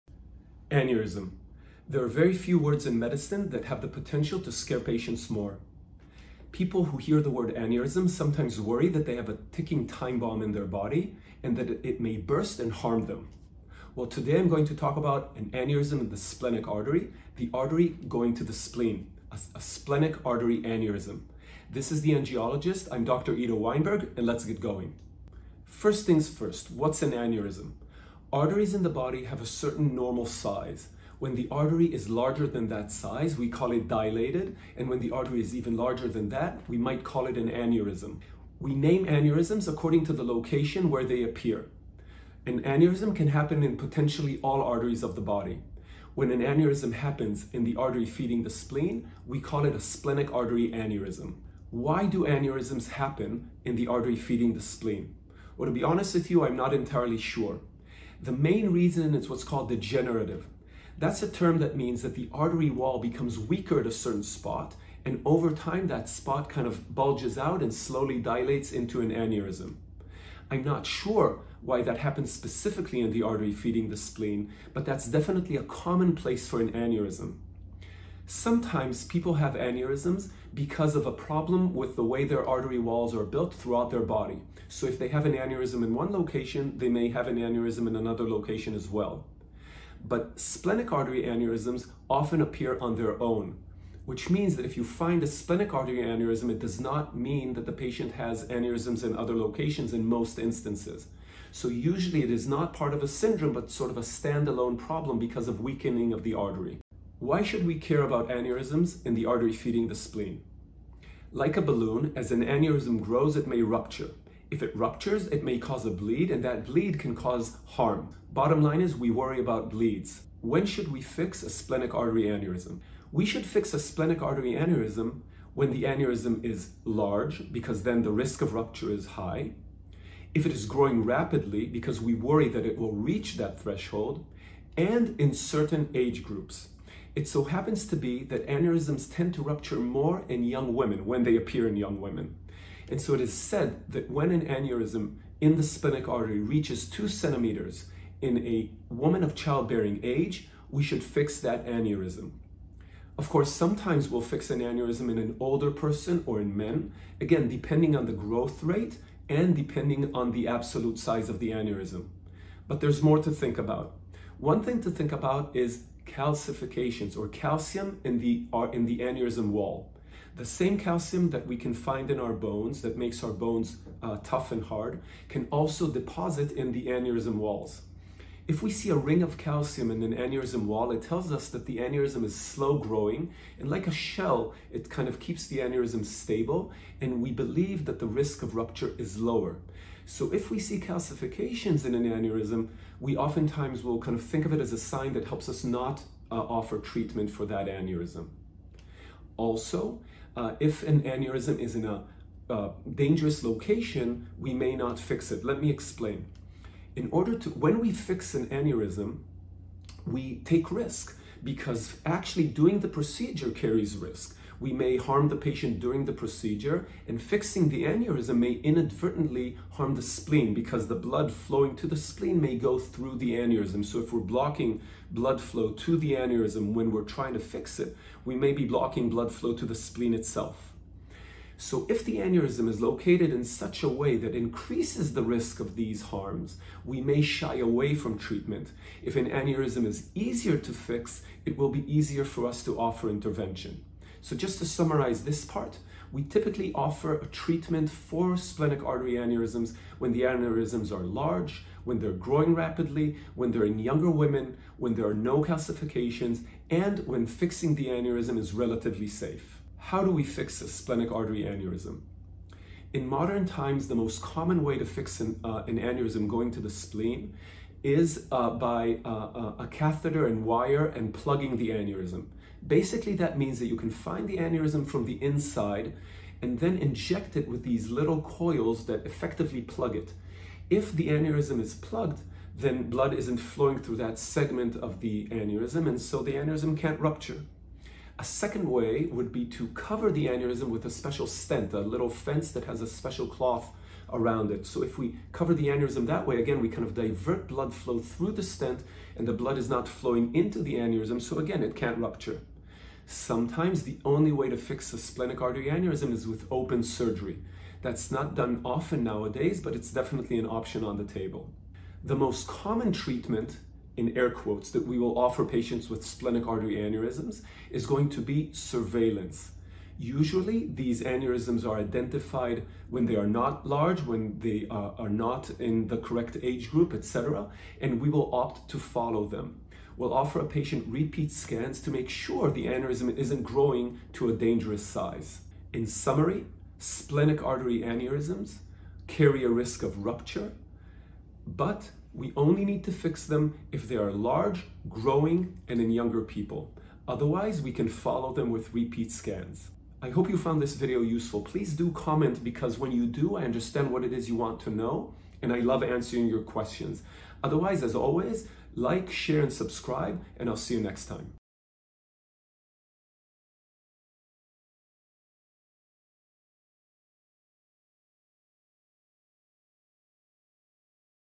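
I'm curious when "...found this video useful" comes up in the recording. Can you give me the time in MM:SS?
05:50.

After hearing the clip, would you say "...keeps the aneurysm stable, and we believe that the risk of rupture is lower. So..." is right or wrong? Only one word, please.
right.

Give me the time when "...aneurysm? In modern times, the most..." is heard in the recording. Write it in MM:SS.
04:21.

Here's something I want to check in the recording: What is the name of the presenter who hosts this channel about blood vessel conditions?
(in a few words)
Ido Weinberg.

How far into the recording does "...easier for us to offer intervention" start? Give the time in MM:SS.
04:01.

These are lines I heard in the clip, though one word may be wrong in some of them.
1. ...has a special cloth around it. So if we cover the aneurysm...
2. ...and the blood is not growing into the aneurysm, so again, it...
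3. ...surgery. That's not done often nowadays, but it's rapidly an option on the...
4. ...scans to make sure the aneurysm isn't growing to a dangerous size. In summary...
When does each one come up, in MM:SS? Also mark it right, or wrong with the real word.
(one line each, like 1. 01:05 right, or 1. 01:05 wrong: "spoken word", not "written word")
1. 04:52 right
2. 04:59 wrong: "flowing", not "growing"
3. 05:06 wrong: "definitely", not "rapidly"
4. 05:31 right.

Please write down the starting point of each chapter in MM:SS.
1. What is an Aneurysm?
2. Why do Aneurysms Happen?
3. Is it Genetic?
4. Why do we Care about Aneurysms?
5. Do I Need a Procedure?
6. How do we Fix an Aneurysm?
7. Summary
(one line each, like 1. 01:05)
1. 00:26
2. 00:51
3. 01:18
4. 01:47
5. 02:00
6. 04:20
7. 05:35.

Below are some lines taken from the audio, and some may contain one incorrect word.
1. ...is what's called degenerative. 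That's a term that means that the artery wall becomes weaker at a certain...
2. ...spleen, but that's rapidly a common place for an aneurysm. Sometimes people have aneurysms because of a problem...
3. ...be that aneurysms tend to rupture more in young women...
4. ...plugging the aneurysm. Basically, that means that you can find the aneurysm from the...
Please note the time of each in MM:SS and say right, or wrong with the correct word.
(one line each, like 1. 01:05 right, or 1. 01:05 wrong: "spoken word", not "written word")
1. 00:59 right
2. 01:13 wrong: "definitely", not "rapidly"
3. 02:17 right
4. 04:31 right.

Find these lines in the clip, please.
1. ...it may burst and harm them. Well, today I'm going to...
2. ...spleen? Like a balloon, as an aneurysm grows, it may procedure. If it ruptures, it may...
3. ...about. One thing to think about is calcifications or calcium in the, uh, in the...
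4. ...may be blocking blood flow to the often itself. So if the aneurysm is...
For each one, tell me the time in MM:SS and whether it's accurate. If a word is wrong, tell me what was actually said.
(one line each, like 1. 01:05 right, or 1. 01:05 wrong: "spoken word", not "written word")
1. 00:11 right
2. 01:49 wrong: "rupture", not "procedure"
3. 02:43 right
4. 03:48 wrong: "spleen", not "often".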